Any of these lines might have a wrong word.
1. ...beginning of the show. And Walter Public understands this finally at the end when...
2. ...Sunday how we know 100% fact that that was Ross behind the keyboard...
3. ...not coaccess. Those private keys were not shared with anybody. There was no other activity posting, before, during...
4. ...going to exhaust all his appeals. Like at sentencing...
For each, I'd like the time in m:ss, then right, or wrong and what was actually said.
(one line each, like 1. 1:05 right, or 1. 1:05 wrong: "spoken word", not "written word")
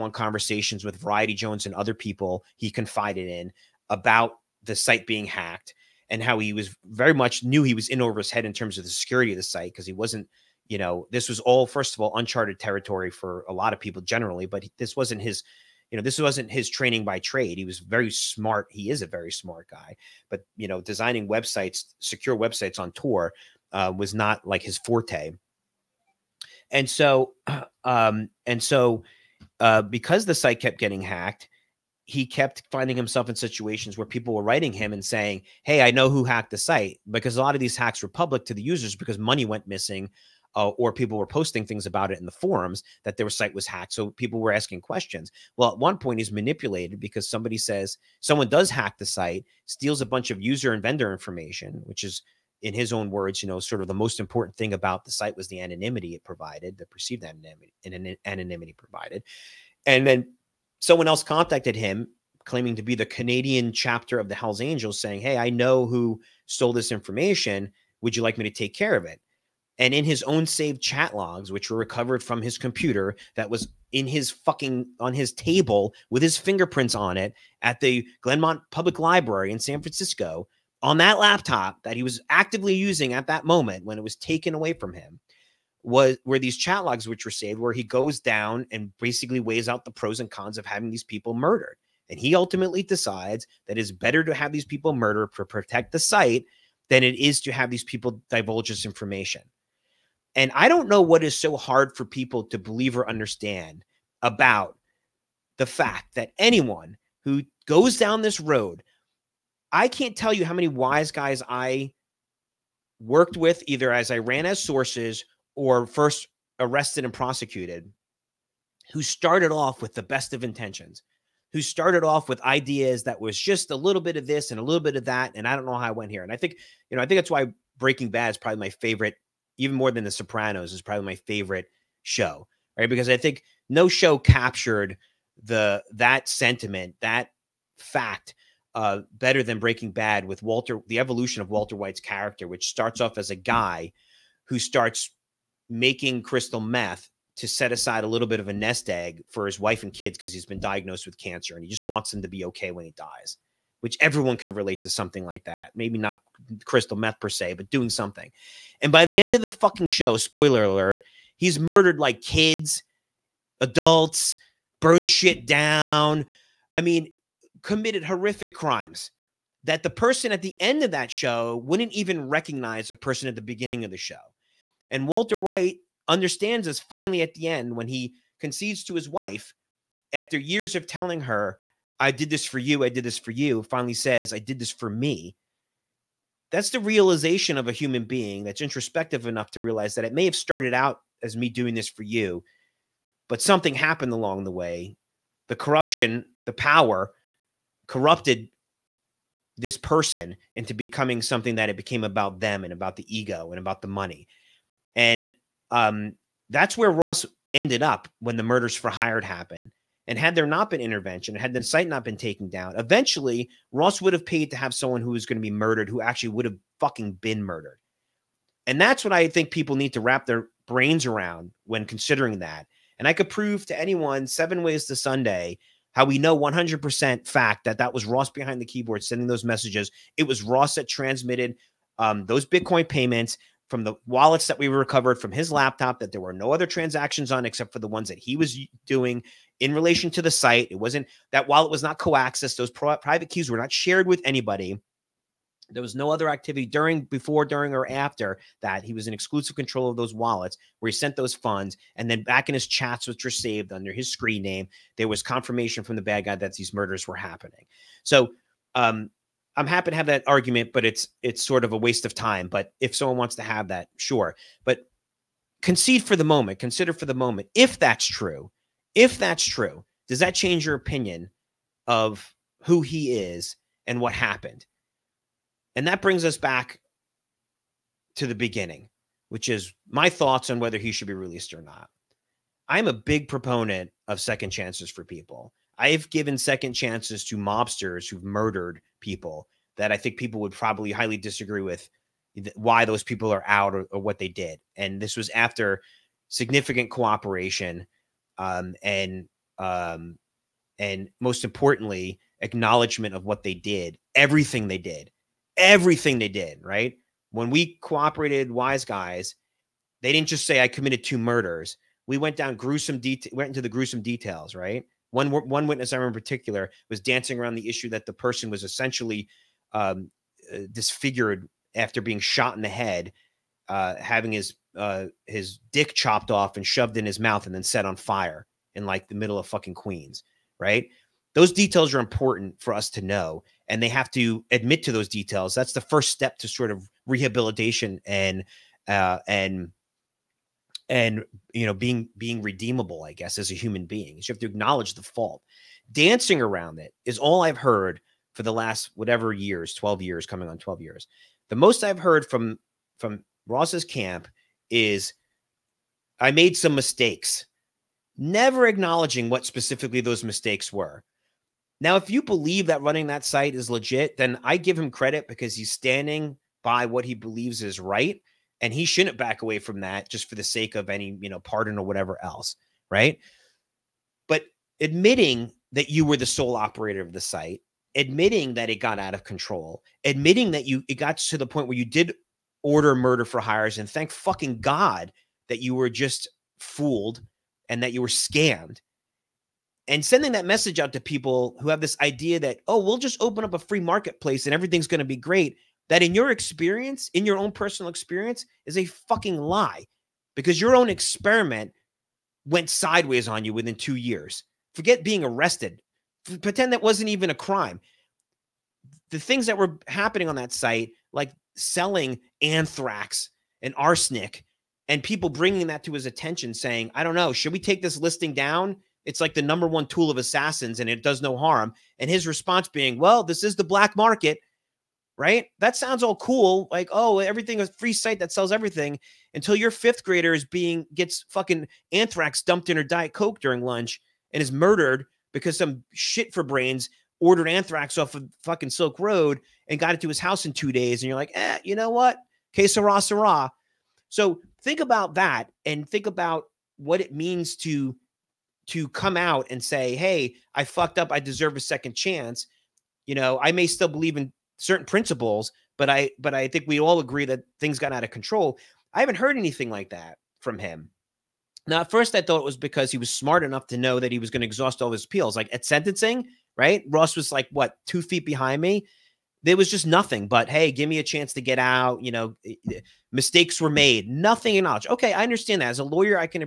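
1. 2:53 wrong: "White", not "Public"
2. 3:44 right
3. 4:01 wrong: "during", not "posting"
4. 7:44 right.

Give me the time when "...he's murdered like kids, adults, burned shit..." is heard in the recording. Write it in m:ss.
2:41.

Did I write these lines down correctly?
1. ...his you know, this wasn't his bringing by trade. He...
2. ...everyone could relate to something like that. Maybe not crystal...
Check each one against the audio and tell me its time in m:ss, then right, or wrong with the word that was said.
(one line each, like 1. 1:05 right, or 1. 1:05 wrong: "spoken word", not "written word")
1. 0:15 wrong: "training", not "bringing"
2. 2:33 right.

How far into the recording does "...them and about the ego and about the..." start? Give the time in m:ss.
3:22.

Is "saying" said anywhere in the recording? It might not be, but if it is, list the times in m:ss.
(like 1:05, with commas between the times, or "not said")
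0:35, 1:04, 6:56.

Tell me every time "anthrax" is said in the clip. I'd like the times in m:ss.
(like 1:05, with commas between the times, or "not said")
6:52, 7:11, 7:17.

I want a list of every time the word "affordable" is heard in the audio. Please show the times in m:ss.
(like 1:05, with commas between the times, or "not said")
not said.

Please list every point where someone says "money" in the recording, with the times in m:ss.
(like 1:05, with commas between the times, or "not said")
0:39, 3:23.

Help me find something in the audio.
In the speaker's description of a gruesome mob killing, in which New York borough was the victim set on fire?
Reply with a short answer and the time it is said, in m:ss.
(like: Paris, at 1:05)
Queens, at 5:29.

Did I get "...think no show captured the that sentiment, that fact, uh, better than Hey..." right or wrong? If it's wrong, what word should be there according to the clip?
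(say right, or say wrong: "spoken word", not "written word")
wrong: "Breaking", not "Hey".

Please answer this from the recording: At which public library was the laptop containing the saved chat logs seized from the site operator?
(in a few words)
Glenmont Public Library.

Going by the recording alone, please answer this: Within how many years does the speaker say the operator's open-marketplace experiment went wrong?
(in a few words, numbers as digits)
2 years.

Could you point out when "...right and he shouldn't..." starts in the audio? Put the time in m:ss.
6:07.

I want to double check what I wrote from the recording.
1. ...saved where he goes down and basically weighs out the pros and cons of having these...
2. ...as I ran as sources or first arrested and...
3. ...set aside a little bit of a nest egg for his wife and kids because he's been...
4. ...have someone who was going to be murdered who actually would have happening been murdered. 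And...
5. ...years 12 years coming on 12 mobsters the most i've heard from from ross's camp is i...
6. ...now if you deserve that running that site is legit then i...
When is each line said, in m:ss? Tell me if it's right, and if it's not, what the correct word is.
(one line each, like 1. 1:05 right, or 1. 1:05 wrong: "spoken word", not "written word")
1. 1:27 right
2. 1:53 right
3. 2:27 right
4. 3:34 wrong: "fucking", not "happening"
5. 5:49 wrong: "years", not "mobsters"
6. 6:01 wrong: "believe", not "deserve".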